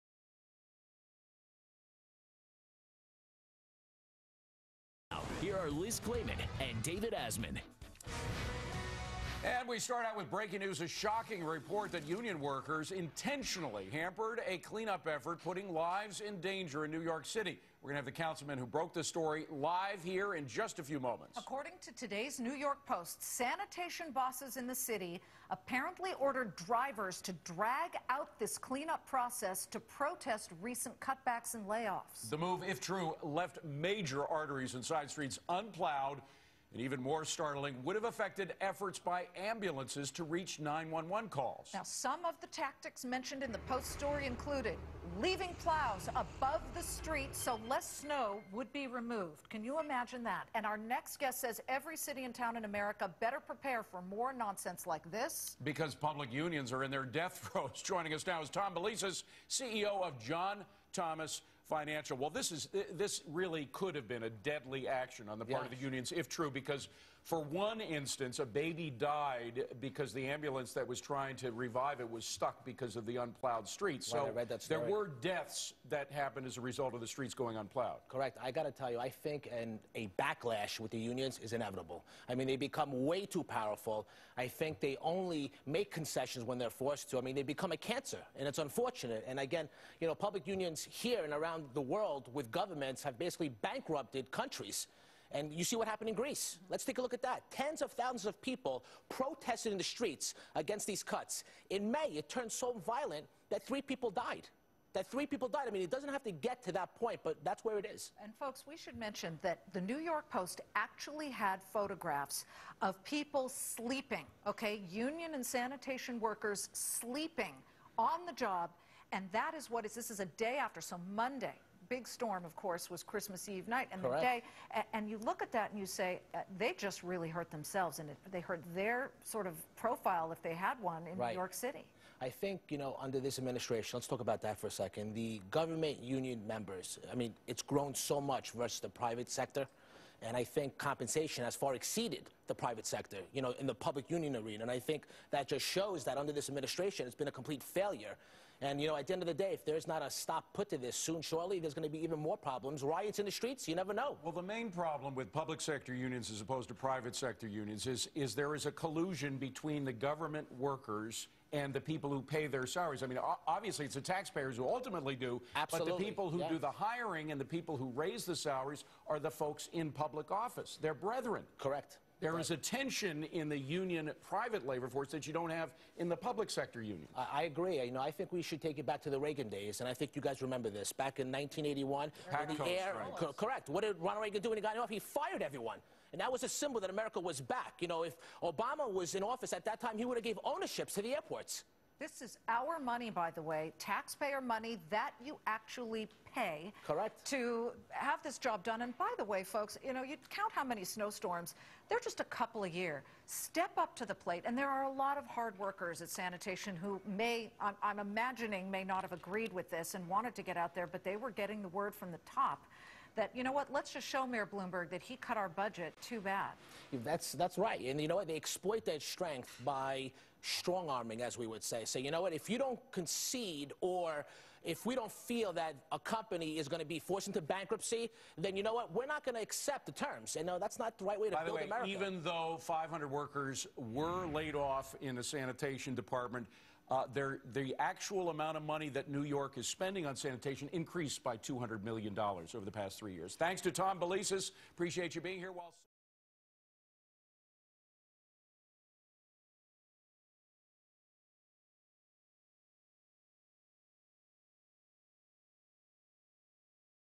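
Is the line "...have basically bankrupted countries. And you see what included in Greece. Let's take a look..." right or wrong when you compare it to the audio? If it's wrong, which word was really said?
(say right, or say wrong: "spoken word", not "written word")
wrong: "happened", not "included".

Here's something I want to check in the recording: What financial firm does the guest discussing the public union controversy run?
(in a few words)
John Thomas Financial.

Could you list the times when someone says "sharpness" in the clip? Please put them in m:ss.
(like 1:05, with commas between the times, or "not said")
not said.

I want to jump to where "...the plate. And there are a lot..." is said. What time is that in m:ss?
3:24.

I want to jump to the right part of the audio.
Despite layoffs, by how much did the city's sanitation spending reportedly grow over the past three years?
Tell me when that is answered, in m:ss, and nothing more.
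4:01.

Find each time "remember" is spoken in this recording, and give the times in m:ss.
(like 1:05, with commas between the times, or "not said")
3:00.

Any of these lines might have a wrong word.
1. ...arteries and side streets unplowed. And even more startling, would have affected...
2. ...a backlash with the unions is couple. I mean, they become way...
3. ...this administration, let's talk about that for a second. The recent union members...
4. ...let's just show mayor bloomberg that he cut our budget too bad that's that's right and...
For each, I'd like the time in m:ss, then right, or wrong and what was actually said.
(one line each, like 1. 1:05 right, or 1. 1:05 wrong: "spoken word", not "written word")
1. 0:34 right
2. 1:19 wrong: "inevitable", not "couple"
3. 2:13 wrong: "government", not "recent"
4. 3:33 right.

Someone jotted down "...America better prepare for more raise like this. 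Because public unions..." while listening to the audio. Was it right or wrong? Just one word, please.
wrong.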